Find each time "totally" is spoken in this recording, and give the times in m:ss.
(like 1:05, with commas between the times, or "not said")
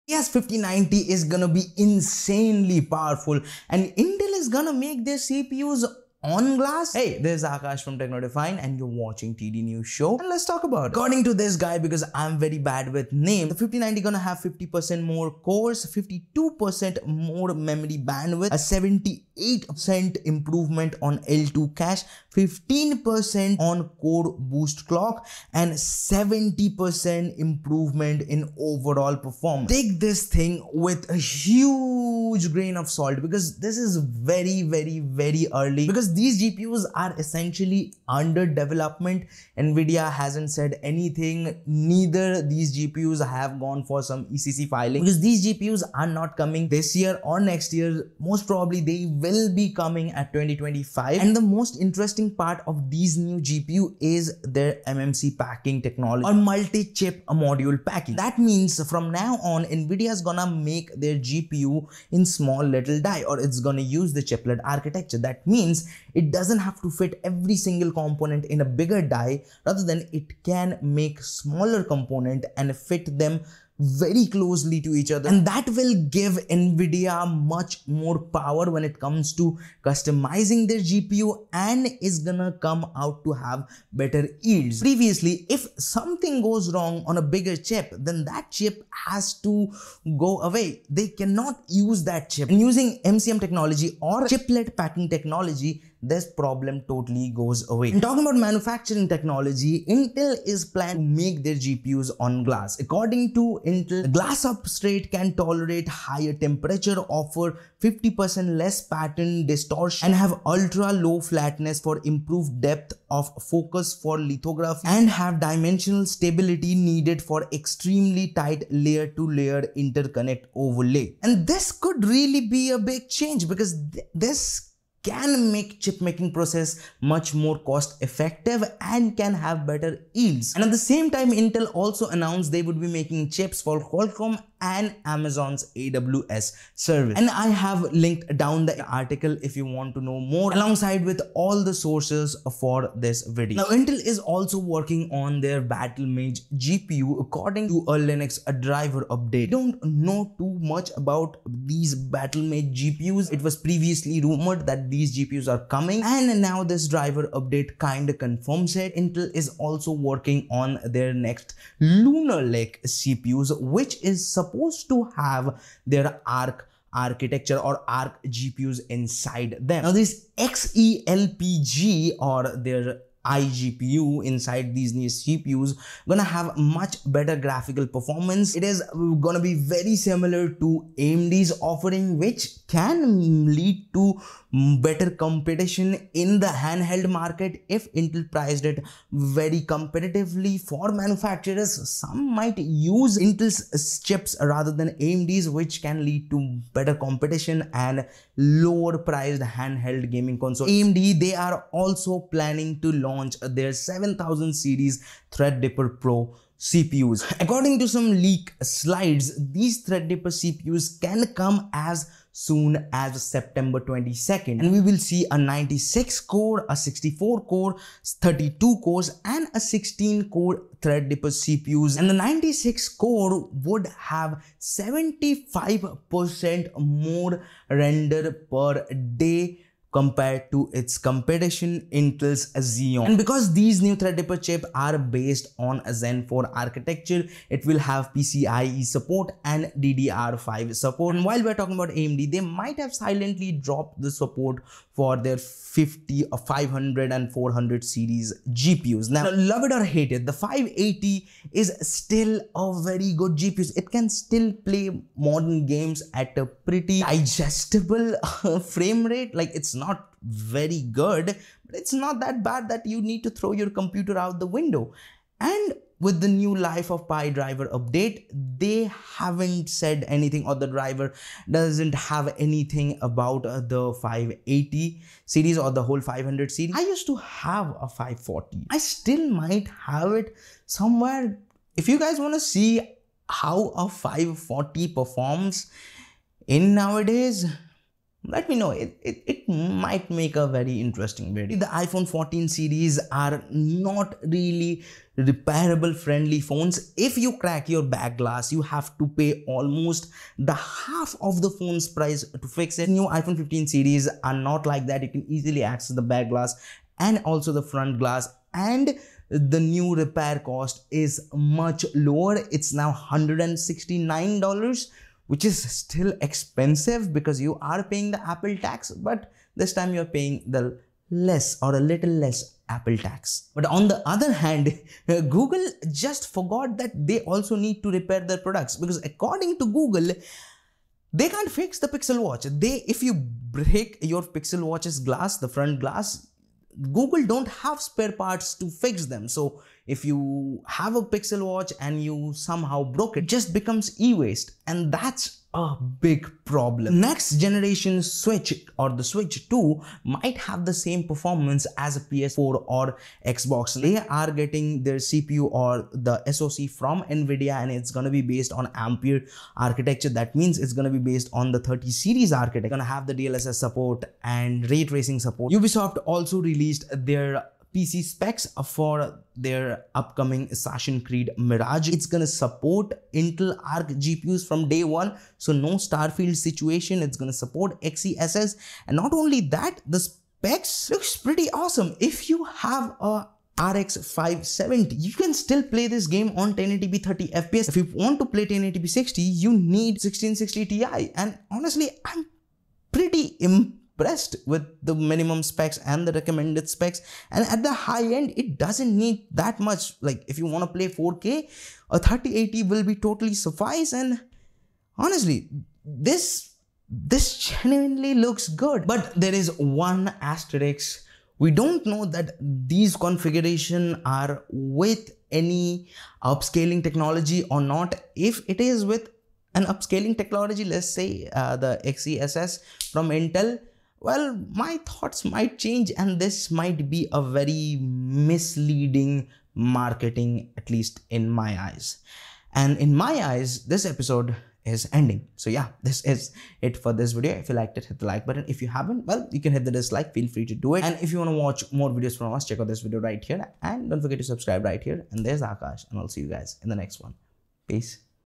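1:36, 6:42.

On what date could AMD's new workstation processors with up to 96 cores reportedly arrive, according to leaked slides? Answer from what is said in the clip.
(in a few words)
September 22nd.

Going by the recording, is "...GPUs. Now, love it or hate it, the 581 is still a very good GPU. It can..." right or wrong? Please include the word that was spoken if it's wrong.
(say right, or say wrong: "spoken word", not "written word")
wrong: "580", not "581".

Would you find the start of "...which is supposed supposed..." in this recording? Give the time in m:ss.
2:43.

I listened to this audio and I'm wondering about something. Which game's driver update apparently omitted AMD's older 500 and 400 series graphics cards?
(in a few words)
Lies of P.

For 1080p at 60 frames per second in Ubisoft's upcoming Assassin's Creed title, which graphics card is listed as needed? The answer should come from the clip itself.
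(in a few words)
GTX 1660 Ti.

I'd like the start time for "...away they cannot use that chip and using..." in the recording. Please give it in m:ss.
1:30.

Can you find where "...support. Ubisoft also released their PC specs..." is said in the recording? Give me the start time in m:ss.
6:05.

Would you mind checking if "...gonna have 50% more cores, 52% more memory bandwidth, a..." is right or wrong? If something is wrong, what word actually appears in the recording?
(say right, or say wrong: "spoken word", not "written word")
right.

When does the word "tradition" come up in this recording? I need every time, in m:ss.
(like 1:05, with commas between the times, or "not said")
not said.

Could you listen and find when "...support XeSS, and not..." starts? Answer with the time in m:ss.
6:17.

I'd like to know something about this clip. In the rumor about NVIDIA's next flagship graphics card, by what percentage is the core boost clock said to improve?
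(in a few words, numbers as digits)
15%.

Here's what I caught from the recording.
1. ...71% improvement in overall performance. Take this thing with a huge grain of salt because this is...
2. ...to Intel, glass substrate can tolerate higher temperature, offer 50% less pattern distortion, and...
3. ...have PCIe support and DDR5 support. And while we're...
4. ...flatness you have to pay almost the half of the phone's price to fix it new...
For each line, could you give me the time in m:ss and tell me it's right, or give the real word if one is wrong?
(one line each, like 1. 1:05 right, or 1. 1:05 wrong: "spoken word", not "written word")
1. 0:25 wrong: "70", not "71"
2. 1:43 right
3. 3:57 right
4. 4:58 wrong: "glass", not "flatness".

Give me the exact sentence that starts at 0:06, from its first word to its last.
Hey, this is Akash from Techno Define and you're watching TD News Show and let's talk about it.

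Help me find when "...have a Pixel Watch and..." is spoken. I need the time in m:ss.
5:40.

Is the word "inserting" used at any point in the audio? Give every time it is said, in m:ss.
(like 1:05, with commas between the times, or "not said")
not said.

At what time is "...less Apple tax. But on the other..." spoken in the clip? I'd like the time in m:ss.
5:22.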